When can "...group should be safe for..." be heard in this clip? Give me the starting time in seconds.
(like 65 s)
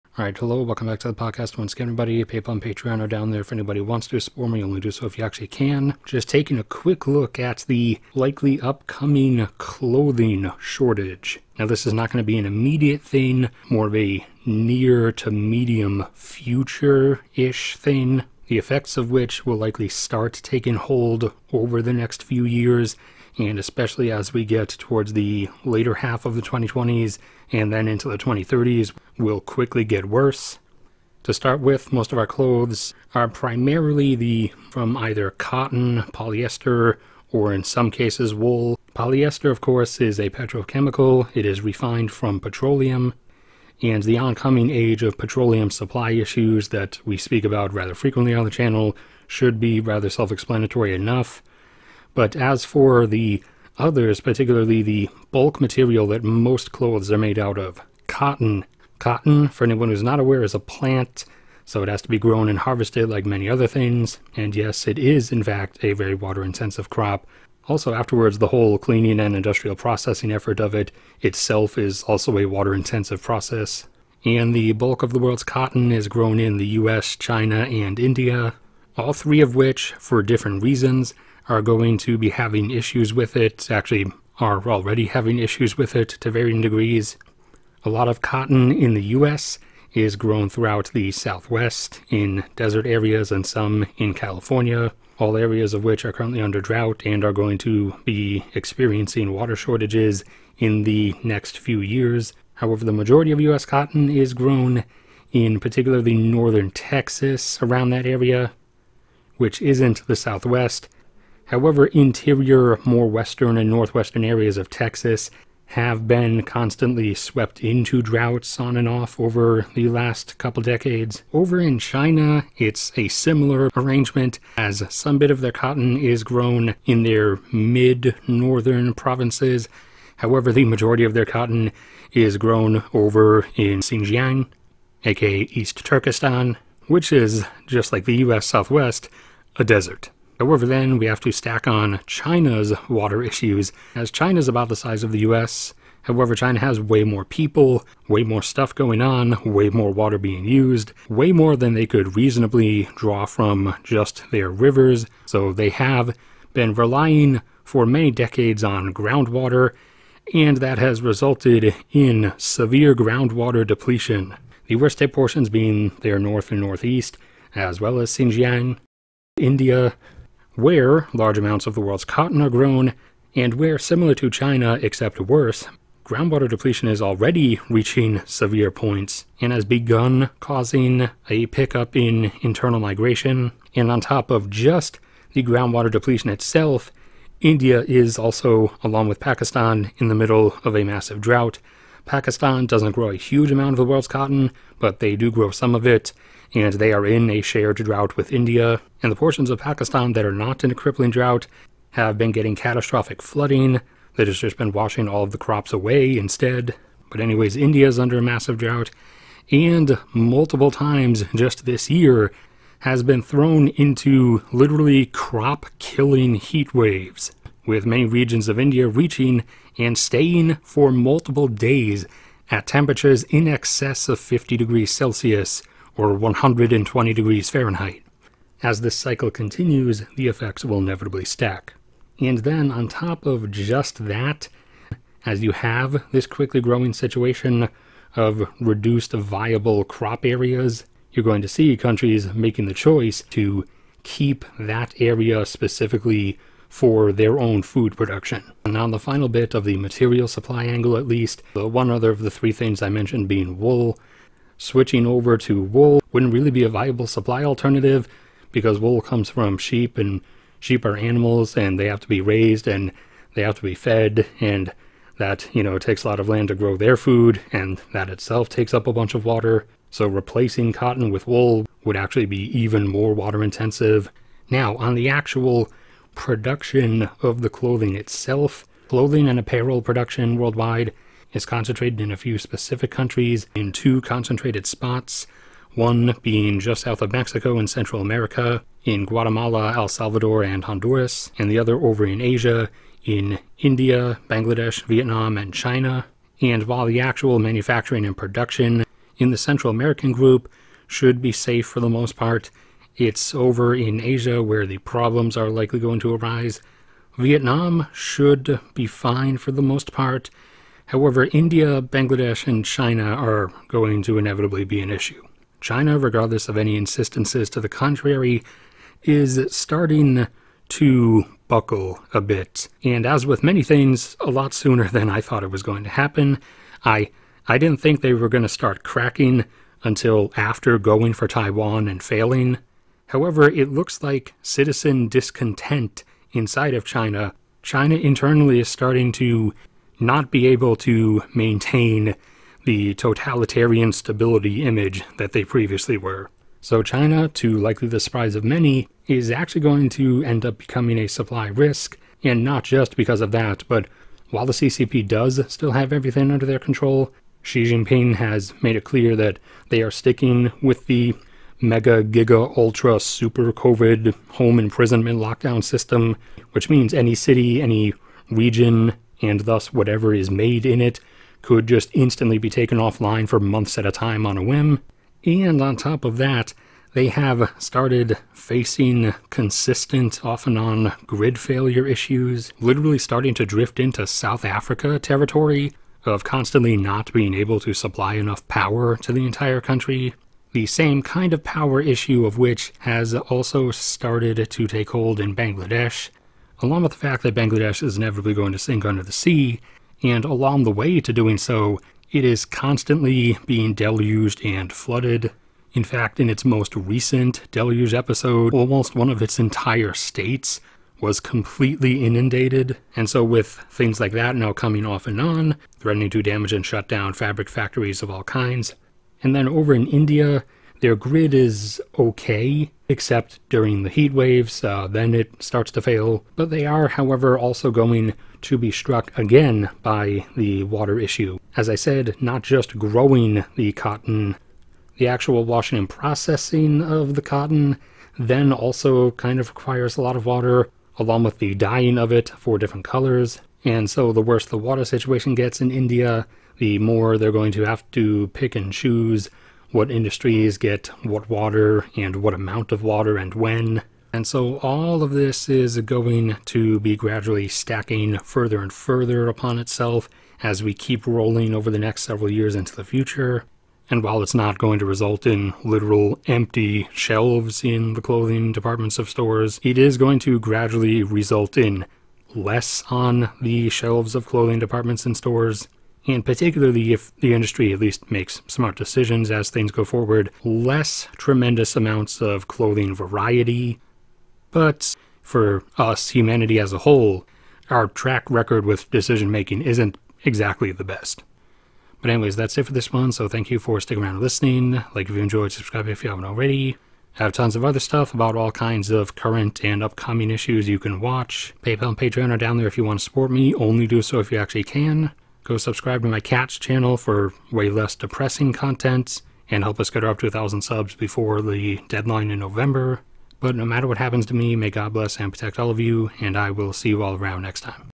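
300 s.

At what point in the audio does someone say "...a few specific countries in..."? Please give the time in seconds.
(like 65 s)
282 s.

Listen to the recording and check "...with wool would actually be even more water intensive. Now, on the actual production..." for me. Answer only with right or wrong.
right.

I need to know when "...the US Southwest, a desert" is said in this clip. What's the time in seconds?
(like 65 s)
138 s.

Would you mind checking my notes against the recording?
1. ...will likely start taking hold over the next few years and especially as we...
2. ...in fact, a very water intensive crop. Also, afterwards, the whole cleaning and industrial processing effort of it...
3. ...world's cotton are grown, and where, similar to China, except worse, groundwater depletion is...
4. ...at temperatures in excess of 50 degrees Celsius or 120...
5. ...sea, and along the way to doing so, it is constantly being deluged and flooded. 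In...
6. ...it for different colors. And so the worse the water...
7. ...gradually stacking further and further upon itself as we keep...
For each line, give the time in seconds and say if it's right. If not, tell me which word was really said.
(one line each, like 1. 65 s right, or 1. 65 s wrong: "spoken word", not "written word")
1. 19 s right
2. 65 s right
3. 171 s right
4. 222 s right
5. 399 s right
6. 442 s right
7. 456 s right.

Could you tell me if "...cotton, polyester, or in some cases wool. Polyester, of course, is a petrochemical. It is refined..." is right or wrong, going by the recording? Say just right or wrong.
right.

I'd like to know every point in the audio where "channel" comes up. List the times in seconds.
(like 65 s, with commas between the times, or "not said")
48 s, 506 s.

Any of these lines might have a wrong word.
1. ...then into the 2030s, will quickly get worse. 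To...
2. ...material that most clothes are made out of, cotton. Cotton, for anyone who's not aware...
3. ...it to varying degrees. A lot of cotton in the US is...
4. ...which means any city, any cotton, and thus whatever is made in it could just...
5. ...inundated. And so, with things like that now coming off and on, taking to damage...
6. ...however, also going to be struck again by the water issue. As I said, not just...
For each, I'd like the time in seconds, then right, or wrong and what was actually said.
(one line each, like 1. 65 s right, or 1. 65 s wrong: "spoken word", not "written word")
1. 27 s right
2. 55 s right
3. 85 s right
4. 366 s wrong: "region", not "cotton"
5. 412 s wrong: "threatening", not "taking"
6. 426 s right.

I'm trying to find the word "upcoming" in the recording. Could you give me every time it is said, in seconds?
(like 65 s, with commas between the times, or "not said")
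8 s, 499 s.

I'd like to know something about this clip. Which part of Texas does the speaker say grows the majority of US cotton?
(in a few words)
Northern Texas.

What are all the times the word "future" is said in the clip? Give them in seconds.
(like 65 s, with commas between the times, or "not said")
16 s, 462 s.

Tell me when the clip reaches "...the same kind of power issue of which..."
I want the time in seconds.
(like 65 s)
390 s.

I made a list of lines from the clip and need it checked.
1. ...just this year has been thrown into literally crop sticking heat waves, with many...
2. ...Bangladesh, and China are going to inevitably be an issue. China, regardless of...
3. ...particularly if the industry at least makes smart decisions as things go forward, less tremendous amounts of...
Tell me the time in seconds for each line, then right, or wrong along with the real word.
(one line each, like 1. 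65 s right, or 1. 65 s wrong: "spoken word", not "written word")
1. 211 s wrong: "killing", not "sticking"
2. 311 s right
3. 476 s right.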